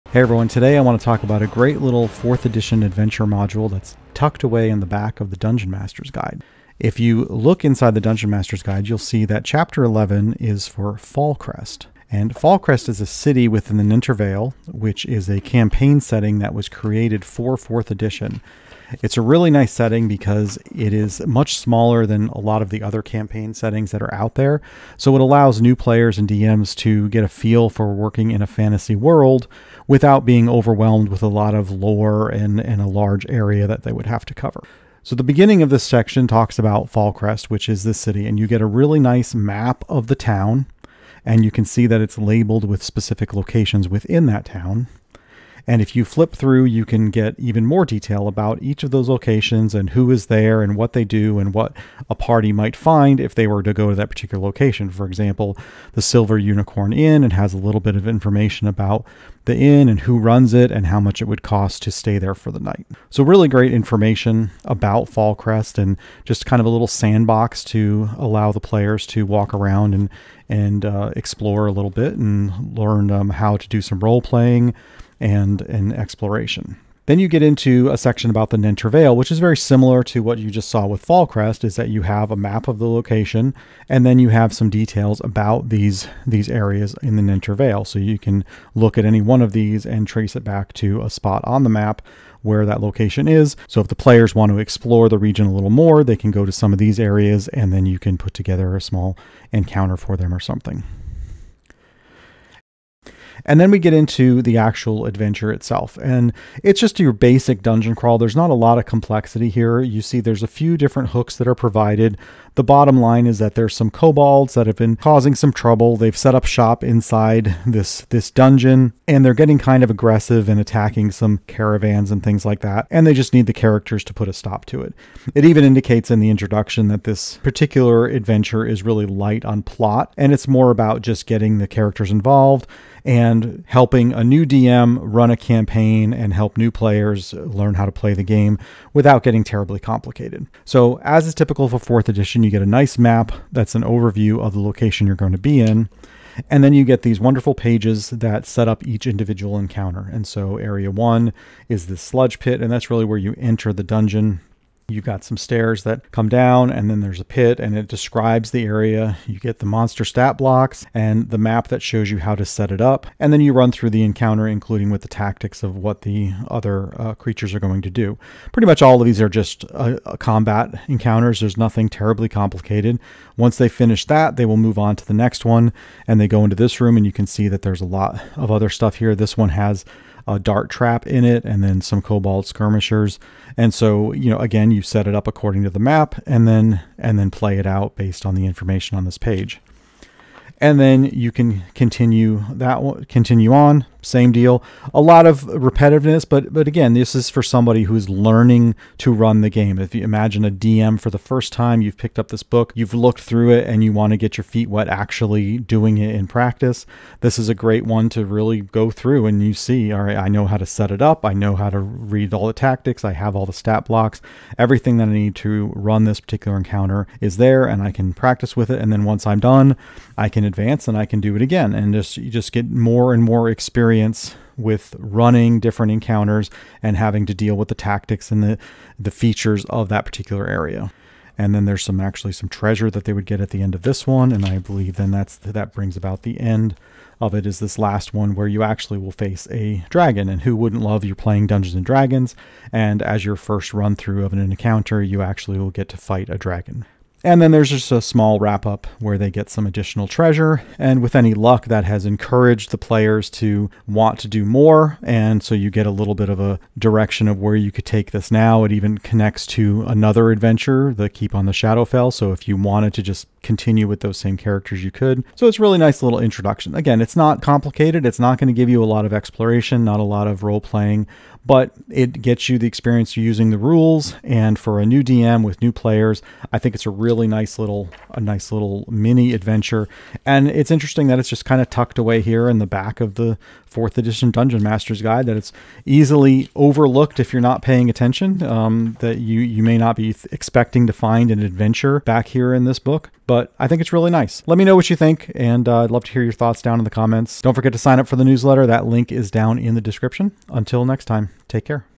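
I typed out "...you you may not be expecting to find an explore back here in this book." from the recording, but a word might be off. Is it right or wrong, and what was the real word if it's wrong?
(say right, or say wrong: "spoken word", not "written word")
wrong: "adventure", not "explore".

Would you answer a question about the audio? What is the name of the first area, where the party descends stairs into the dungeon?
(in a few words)
The sludge pit.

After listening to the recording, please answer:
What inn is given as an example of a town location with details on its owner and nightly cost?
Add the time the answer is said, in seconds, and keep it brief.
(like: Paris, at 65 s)
Silver Unicorn Inn, at 56 s.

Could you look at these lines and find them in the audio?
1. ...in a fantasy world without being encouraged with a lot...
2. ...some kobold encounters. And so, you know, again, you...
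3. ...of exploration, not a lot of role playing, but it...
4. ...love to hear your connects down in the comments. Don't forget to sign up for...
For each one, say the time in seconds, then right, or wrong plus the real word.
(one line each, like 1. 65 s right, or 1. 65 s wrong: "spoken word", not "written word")
1. 28 s wrong: "overwhelmed", not "encouraged"
2. 181 s wrong: "skirmishers", not "encounters"
3. 269 s right
4. 295 s wrong: "thoughts", not "connects".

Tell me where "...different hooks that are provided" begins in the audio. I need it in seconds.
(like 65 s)
110 s.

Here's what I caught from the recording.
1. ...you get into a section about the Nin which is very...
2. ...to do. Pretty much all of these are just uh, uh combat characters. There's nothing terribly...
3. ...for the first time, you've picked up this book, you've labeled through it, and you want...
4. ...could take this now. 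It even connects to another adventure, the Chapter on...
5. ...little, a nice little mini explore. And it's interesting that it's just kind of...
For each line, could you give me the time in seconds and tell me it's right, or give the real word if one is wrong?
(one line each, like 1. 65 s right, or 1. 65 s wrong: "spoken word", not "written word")
1. 77 s right
2. 167 s wrong: "encounters", not "characters"
3. 200 s wrong: "looked", not "labeled"
4. 257 s wrong: "Keep", not "Chapter"
5. 277 s wrong: "adventure", not "explore".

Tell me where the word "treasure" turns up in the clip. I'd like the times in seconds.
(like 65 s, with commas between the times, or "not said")
232 s, 250 s.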